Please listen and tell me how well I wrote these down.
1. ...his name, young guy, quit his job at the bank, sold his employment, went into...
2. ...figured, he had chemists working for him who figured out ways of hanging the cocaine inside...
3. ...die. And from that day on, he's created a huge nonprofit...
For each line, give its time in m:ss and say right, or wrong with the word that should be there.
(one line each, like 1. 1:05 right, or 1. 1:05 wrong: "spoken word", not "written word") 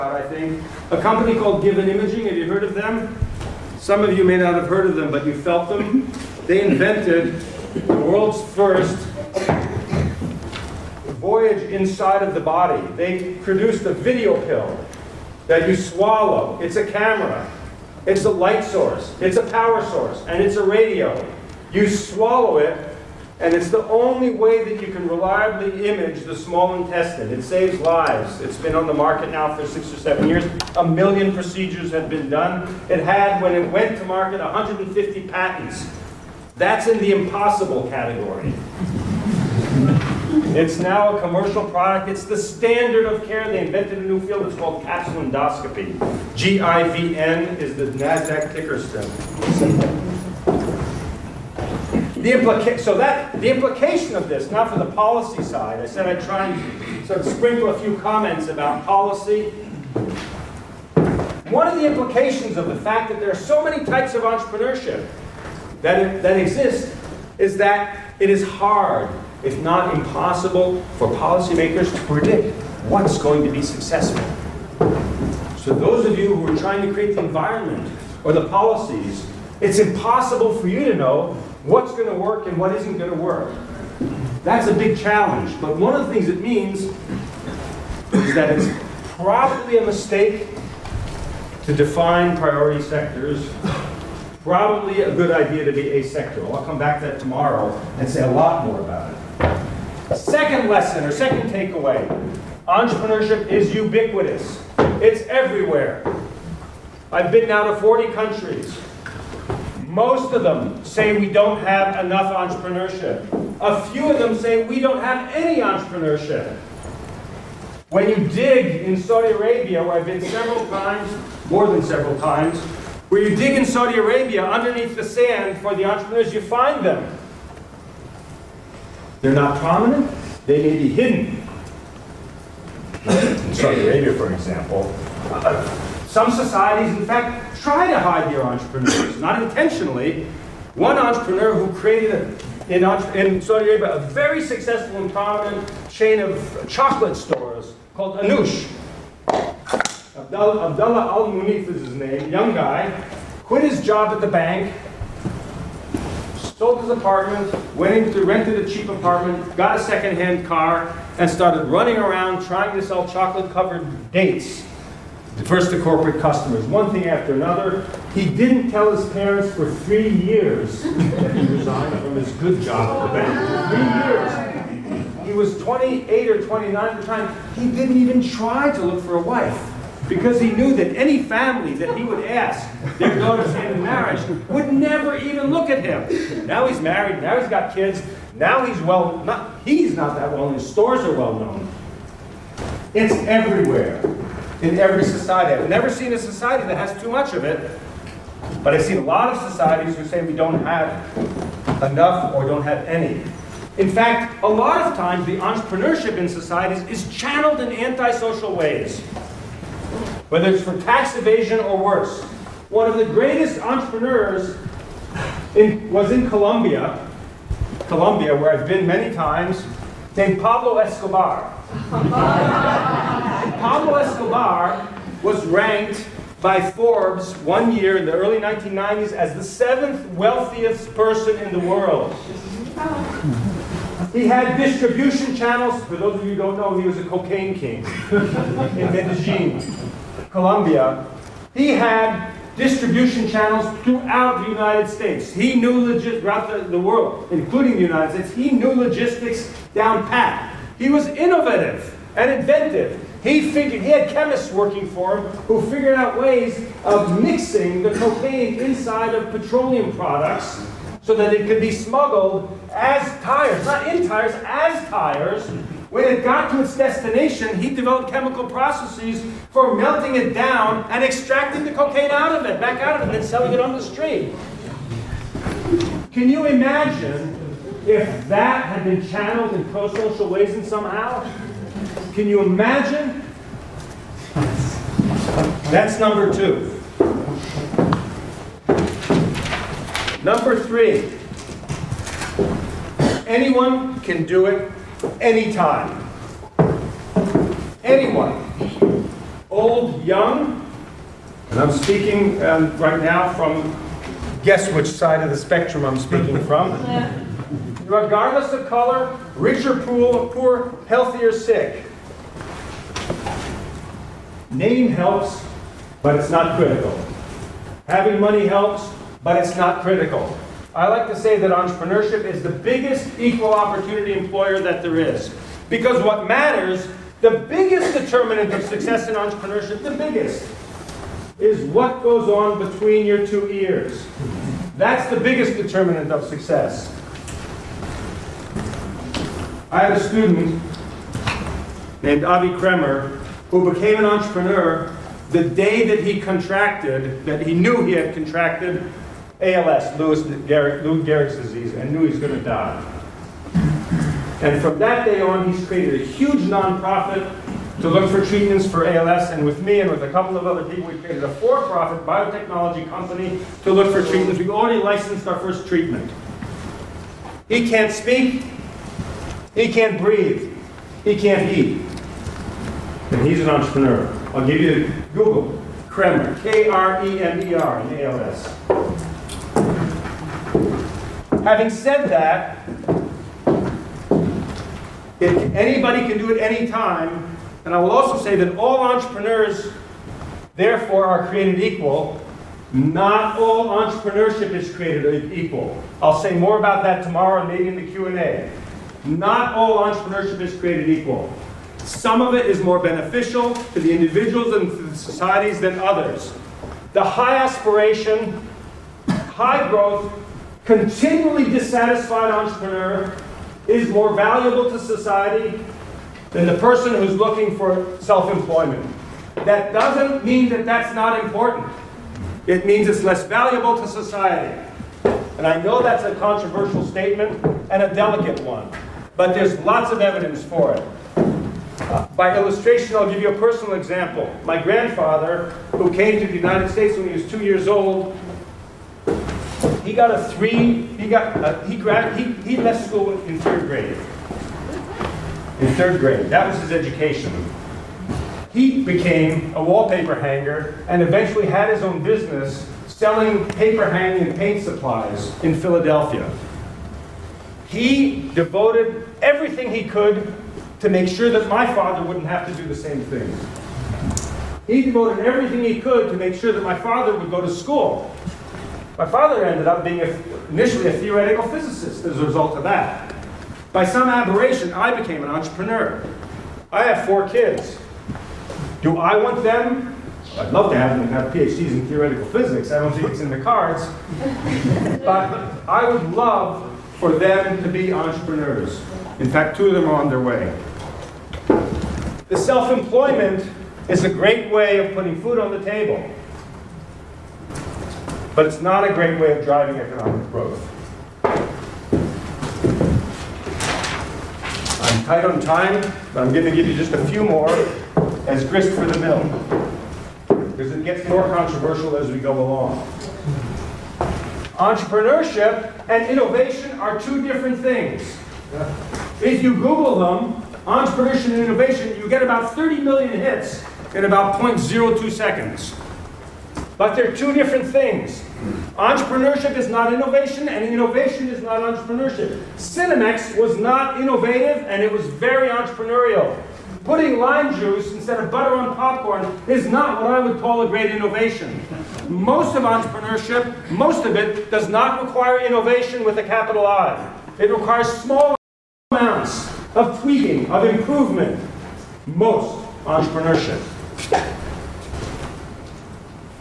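1. 2:31 wrong: "apartment", not "employment"
2. 4:13 wrong: "mixing", not "hanging"
3. 5:52 right.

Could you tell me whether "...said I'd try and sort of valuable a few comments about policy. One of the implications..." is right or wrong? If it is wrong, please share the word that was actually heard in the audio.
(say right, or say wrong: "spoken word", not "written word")
wrong: "sprinkle", not "valuable".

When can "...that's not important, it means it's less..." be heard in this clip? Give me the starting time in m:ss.
7:00.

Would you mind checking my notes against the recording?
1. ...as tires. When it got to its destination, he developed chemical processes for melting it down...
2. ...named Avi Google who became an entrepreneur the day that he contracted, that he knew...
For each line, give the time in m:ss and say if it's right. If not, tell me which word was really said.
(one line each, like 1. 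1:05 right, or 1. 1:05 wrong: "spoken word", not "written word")
1. 4:24 right
2. 5:42 wrong: "Kremer", not "Google".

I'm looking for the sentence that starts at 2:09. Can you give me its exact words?
They're not prominent, they may be hidden.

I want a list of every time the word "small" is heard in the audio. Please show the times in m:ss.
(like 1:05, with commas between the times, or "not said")
0:26, 9:07.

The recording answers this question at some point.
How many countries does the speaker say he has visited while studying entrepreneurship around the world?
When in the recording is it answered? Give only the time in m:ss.
1:47.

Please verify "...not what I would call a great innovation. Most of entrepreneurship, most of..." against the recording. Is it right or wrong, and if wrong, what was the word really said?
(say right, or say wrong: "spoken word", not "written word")
right.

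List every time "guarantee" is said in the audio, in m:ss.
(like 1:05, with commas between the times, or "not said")
not said.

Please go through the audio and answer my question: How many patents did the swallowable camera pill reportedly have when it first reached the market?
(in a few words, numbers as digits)
150.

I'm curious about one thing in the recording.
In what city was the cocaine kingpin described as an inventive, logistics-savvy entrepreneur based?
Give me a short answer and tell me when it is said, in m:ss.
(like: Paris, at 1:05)
Medellin, at 3:58.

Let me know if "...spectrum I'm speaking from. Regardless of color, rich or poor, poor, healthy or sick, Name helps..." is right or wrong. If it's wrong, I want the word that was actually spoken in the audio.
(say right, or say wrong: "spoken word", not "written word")
right.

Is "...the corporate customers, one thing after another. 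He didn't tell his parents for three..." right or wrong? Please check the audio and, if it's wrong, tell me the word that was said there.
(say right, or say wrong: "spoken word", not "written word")
right.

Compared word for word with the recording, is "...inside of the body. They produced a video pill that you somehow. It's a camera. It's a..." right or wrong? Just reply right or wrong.
wrong.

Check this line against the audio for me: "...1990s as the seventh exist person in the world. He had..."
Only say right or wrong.
wrong.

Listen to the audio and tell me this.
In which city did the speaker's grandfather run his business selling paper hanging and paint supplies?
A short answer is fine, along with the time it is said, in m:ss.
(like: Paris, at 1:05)
Philadelphia, at 7:35.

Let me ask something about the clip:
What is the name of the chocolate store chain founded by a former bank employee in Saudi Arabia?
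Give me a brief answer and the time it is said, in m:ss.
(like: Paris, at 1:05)
Anush, at 2:28.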